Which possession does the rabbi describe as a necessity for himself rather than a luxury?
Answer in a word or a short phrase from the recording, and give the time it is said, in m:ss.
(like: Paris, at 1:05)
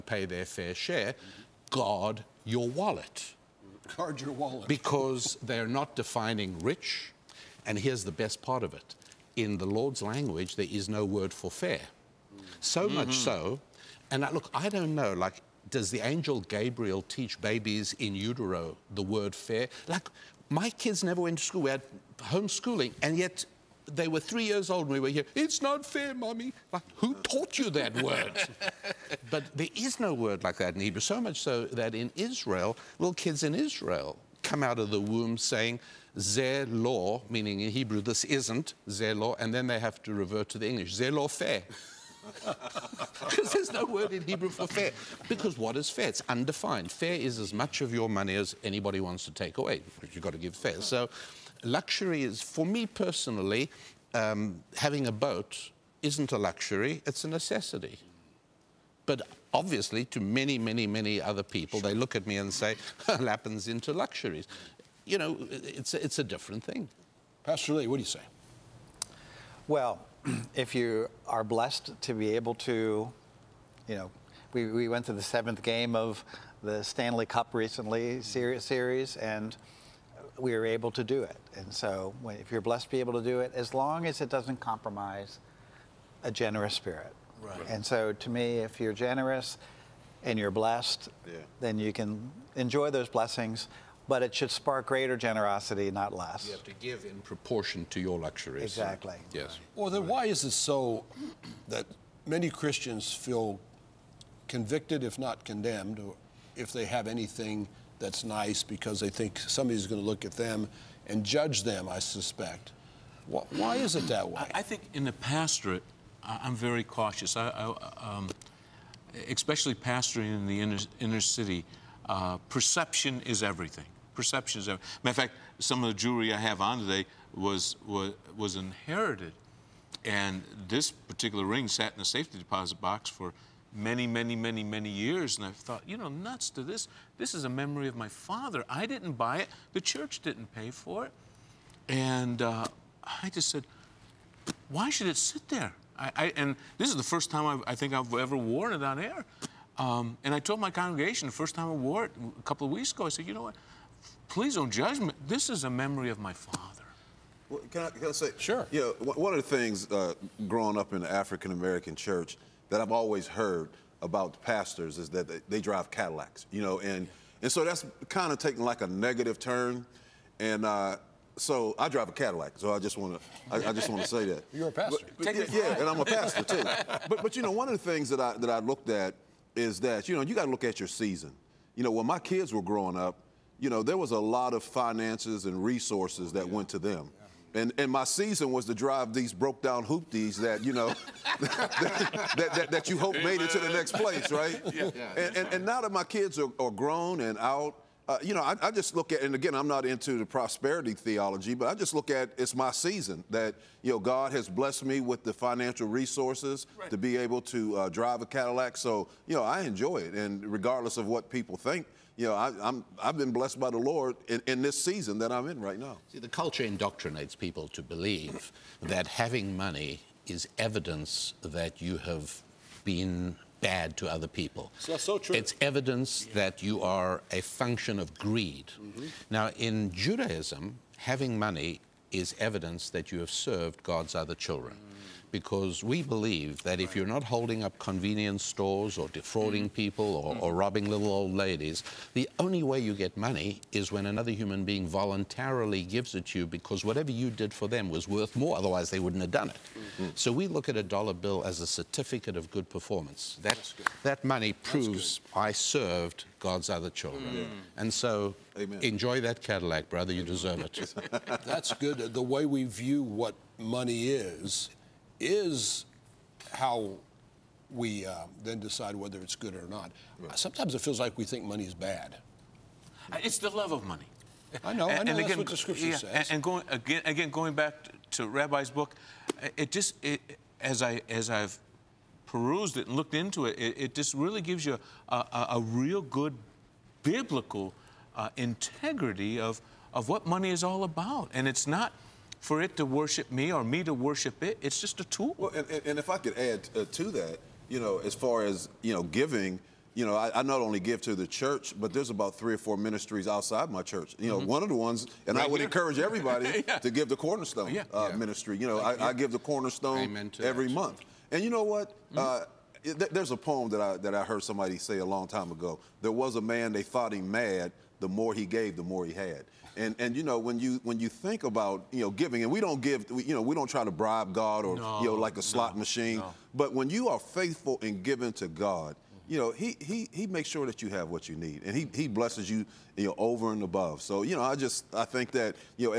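a boat, at 0:54.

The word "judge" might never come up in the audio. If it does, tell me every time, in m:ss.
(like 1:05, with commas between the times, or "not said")
1:51, 2:34.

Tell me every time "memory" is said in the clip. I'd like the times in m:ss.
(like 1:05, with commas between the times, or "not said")
2:17, 2:35.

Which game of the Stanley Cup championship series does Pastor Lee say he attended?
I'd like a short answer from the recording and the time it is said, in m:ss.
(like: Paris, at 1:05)
seventh game, at 1:15.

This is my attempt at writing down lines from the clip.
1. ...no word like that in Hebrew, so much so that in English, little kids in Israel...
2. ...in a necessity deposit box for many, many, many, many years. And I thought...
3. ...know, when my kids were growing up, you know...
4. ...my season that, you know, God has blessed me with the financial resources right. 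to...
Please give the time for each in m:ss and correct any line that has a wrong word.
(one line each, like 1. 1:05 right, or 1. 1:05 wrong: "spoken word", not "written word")
1. 0:29 wrong: "Israel", not "English"
2. 2:11 wrong: "safety", not "necessity"
3. 3:01 right
4. 3:22 right.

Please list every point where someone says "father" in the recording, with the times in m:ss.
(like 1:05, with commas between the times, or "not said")
2:18, 2:36.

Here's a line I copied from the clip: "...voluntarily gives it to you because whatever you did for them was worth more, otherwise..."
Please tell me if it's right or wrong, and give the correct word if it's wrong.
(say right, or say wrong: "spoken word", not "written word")
right.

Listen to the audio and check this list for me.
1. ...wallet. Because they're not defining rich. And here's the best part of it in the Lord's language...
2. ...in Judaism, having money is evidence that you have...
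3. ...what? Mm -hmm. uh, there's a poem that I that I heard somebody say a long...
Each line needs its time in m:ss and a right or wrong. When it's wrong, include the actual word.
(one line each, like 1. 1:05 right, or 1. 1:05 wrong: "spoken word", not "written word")
1. 0:04 right
2. 3:49 right
3. 5:11 right.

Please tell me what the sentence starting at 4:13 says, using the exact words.
That, that money proves I served God's other children.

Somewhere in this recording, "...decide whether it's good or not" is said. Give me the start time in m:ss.
4:28.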